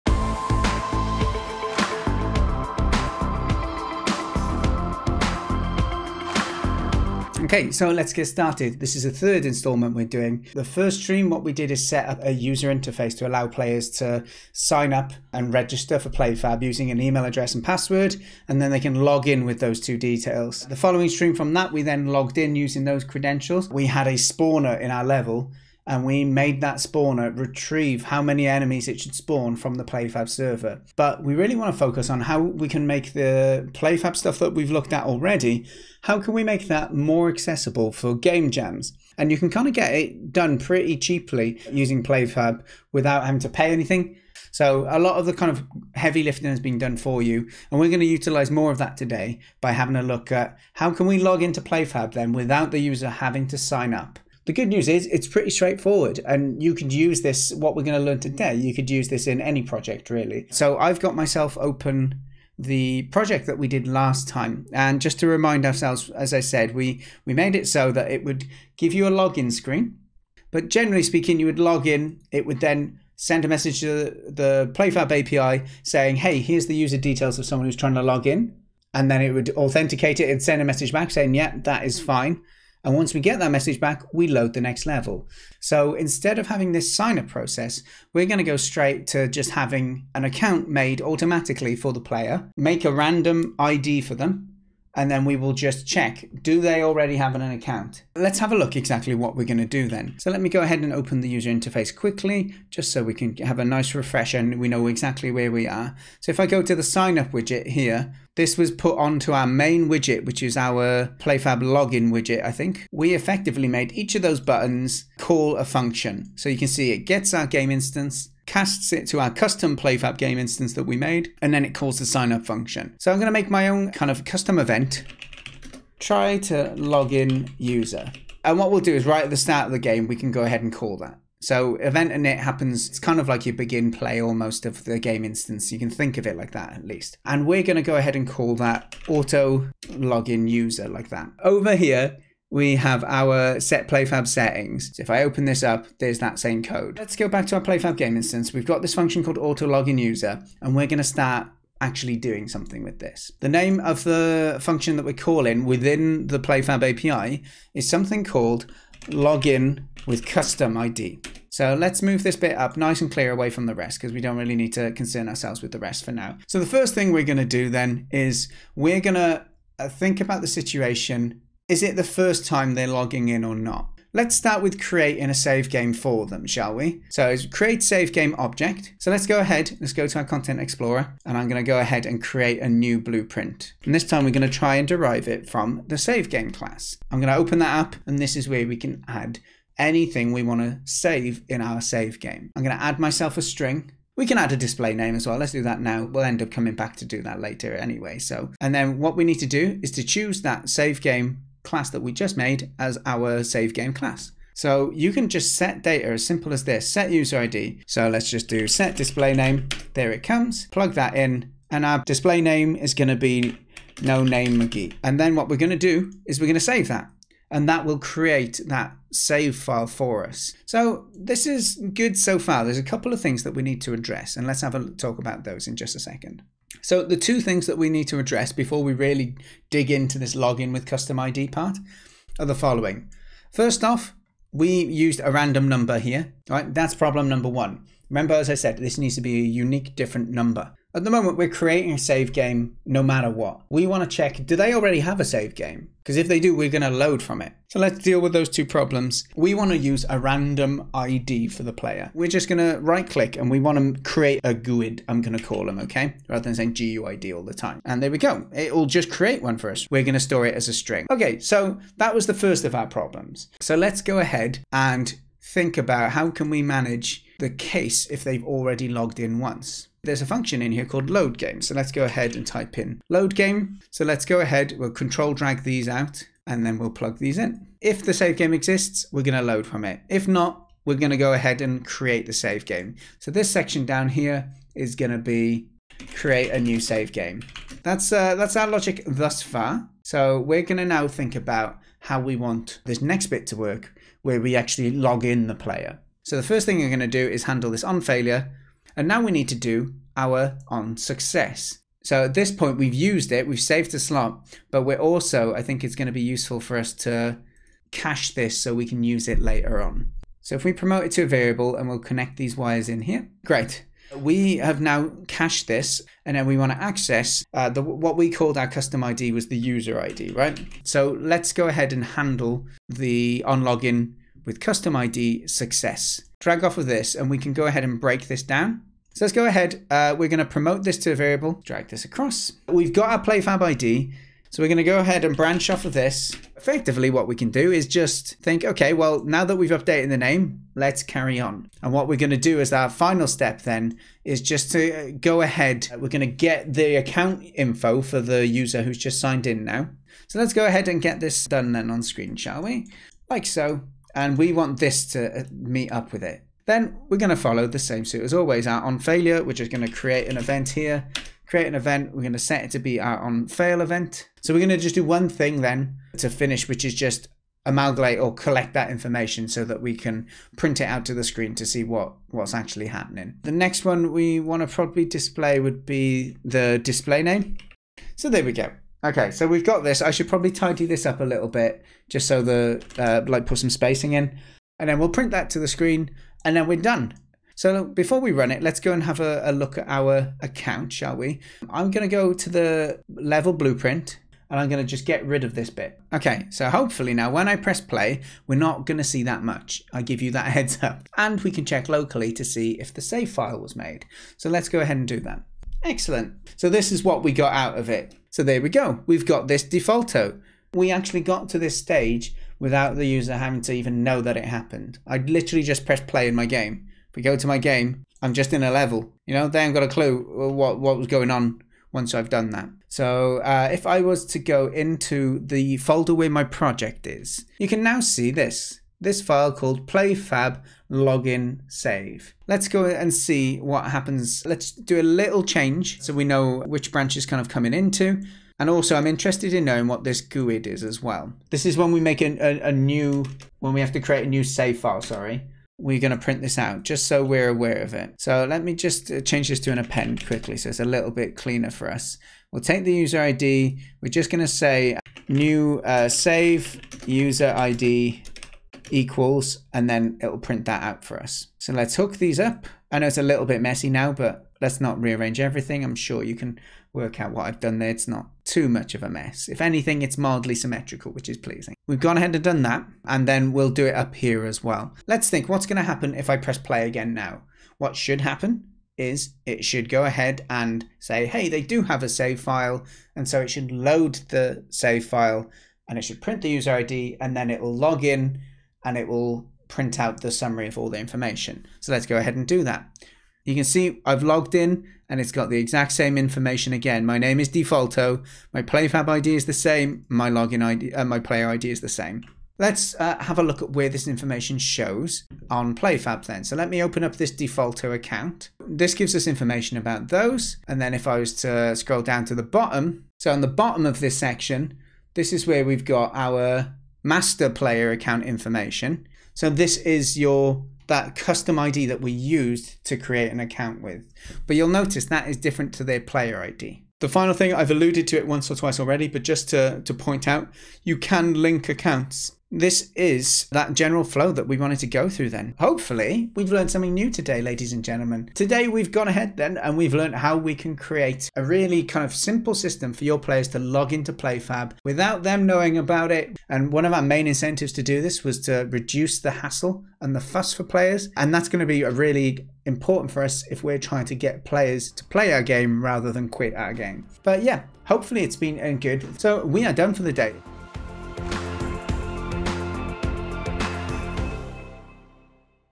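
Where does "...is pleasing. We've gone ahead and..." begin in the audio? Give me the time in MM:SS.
07:51.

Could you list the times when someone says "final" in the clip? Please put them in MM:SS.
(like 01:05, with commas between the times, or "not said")
05:42, 08:47.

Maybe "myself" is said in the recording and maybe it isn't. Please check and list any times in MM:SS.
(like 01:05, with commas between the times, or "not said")
01:01, 03:12.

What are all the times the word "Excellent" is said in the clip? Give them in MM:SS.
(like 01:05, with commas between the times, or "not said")
06:45.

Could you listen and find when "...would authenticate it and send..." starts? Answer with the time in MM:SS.
01:19.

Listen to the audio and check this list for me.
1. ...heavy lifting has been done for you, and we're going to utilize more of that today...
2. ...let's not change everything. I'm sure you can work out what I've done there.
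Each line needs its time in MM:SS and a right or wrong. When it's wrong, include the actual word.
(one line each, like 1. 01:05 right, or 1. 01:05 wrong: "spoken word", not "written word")
1. 00:45 right
2. 07:44 wrong: "rearrange", not "change".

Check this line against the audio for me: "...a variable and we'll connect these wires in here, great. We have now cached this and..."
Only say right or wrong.
right.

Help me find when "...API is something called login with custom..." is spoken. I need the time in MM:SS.
02:36.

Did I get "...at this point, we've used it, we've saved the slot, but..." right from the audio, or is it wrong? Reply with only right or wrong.
right.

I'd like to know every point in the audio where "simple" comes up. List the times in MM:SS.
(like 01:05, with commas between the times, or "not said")
03:26, 09:02.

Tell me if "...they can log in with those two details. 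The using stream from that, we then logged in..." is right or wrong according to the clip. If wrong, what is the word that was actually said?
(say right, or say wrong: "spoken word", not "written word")
wrong: "following", not "using".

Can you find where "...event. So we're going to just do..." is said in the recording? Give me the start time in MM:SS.
06:03.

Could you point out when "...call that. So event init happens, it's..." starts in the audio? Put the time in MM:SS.
02:10.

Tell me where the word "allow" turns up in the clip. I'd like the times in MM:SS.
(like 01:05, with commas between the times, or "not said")
00:13.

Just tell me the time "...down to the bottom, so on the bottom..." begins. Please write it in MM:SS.
08:32.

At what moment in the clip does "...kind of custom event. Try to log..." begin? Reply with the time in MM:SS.
02:03.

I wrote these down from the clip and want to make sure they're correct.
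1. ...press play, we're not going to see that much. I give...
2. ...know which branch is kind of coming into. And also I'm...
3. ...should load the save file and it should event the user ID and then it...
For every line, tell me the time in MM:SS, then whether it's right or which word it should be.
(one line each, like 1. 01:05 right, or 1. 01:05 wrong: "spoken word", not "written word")
1. 06:37 right
2. 07:16 right
3. 08:03 wrong: "print", not "event".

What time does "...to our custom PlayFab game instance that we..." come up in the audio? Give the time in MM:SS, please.
01:59.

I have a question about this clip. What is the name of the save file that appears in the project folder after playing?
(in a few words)
PlayFab login save.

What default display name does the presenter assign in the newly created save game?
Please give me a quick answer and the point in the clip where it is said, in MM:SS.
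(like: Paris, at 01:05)
No Name McGee, at 03:34.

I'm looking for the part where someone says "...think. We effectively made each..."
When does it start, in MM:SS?
01:52.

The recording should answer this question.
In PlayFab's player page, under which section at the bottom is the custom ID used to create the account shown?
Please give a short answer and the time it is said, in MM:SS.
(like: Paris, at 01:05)
Master player account, at 08:37.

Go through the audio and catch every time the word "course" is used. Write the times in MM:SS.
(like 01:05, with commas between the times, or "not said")
not said.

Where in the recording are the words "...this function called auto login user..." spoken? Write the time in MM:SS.
02:28.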